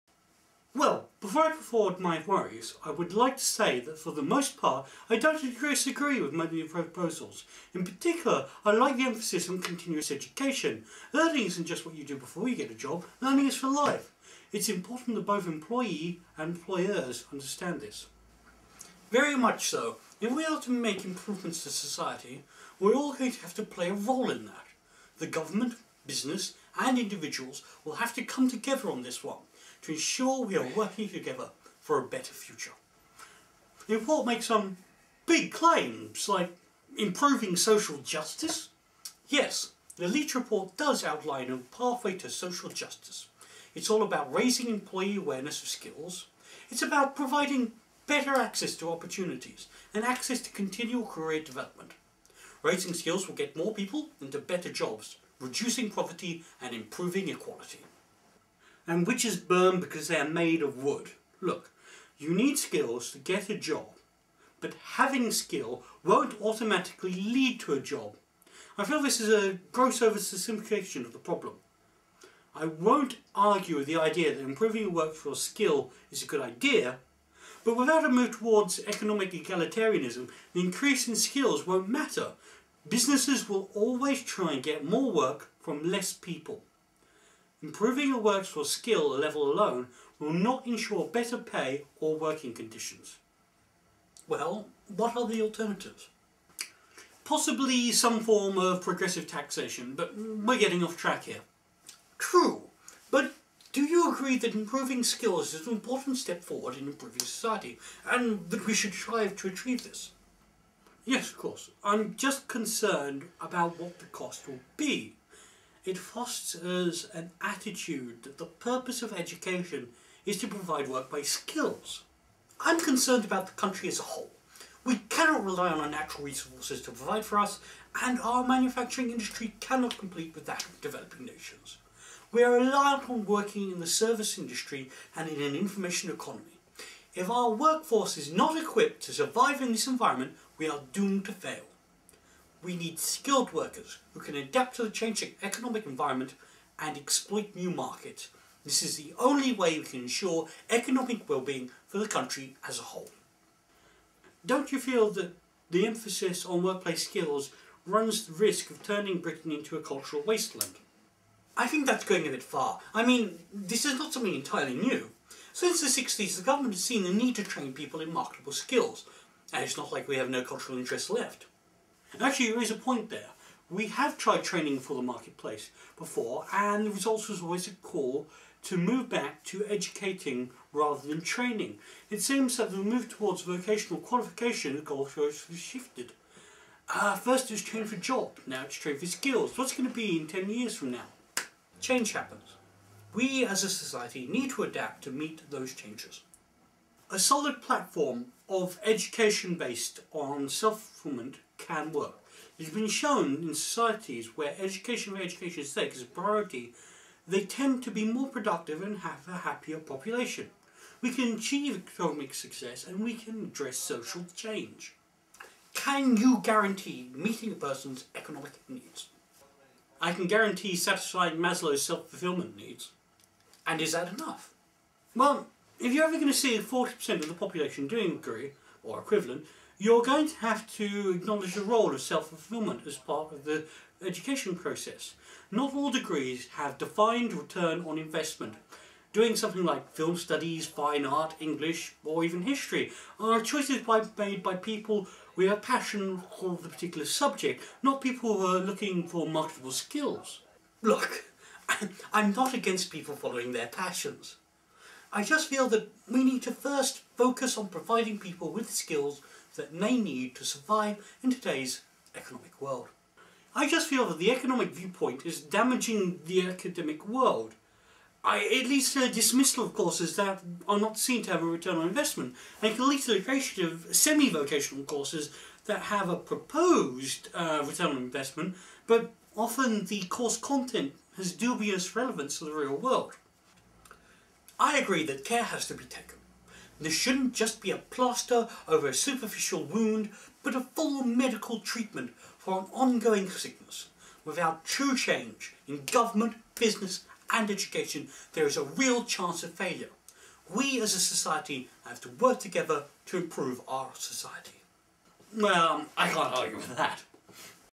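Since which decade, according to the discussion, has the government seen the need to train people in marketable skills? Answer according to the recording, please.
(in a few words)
The 60s.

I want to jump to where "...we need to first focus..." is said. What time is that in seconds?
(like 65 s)
256 s.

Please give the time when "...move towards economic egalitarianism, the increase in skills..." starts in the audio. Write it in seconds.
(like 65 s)
78 s.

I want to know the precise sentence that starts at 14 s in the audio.
It's important that both employee and employers understand this.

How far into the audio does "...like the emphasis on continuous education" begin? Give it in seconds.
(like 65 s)
8 s.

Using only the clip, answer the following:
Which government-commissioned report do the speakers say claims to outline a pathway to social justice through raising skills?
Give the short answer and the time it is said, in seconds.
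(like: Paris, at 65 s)
Leitch report, at 40 s.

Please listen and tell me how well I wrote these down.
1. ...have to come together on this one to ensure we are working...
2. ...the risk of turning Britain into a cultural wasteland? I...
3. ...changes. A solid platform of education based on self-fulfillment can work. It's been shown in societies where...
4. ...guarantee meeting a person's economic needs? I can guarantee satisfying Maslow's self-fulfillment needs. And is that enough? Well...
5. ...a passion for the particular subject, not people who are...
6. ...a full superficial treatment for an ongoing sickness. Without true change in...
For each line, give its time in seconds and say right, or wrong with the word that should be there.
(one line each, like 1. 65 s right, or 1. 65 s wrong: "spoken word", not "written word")
1. 27 s right
2. 158 s right
3. 195 s right
4. 216 s right
5. 245 s right
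6. 290 s wrong: "medical", not "superficial".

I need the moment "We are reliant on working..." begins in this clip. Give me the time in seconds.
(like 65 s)
132 s.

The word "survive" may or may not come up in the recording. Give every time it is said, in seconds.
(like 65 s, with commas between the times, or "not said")
139 s, 260 s.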